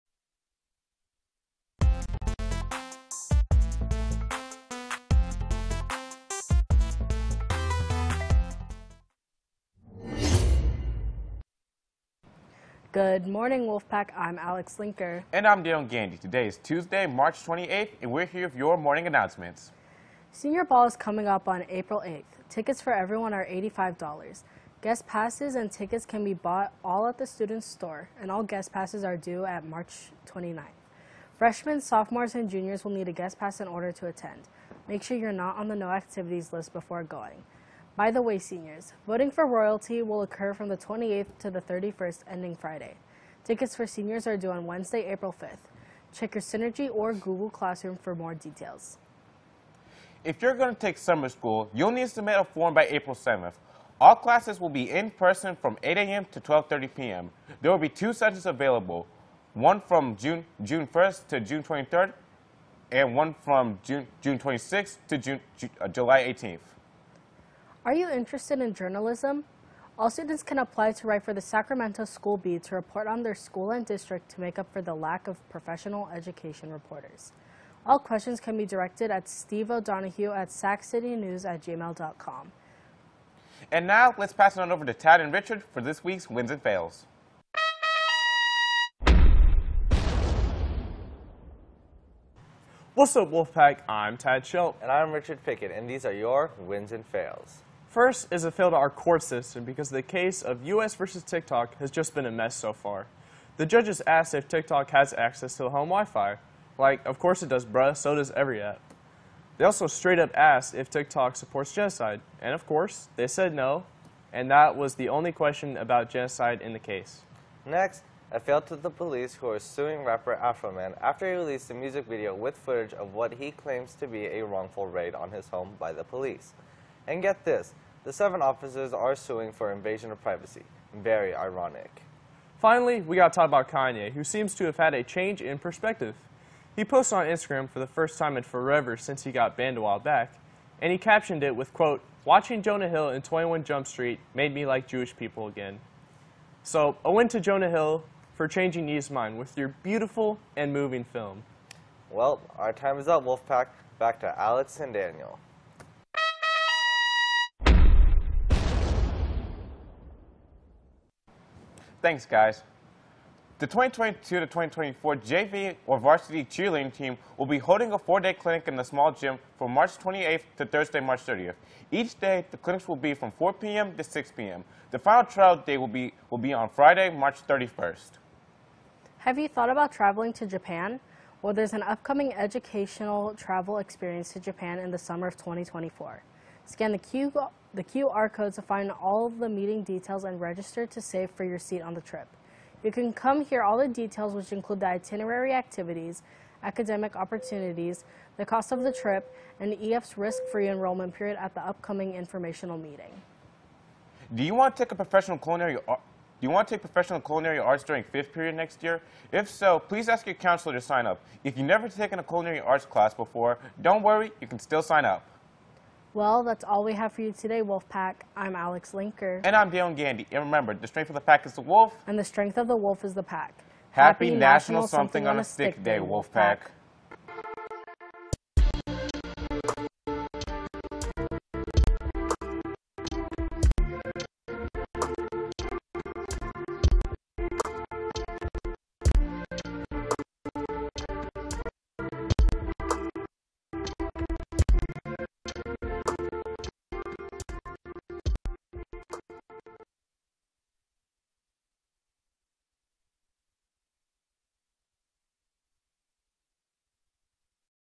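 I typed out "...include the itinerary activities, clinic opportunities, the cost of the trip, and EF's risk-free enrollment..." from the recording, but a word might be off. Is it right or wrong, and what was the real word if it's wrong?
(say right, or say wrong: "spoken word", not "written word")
wrong: "academic", not "clinic".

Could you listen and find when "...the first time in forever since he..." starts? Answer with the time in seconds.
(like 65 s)
137 s.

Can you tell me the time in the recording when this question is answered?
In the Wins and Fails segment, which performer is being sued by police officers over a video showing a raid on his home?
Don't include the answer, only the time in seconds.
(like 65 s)
120 s.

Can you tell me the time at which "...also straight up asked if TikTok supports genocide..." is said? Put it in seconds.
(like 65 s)
109 s.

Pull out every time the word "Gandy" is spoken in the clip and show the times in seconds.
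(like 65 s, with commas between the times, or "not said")
15 s, 219 s.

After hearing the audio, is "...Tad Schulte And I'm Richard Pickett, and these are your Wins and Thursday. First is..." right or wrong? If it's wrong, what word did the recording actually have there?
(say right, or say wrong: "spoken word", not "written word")
wrong: "Fails", not "Thursday".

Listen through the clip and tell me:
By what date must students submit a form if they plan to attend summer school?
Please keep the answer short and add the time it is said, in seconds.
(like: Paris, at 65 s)
April 7th, at 52 s.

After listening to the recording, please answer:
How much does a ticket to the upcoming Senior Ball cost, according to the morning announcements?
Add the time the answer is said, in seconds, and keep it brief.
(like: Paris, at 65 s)
$85, at 23 s.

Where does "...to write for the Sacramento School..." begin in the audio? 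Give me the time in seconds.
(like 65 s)
70 s.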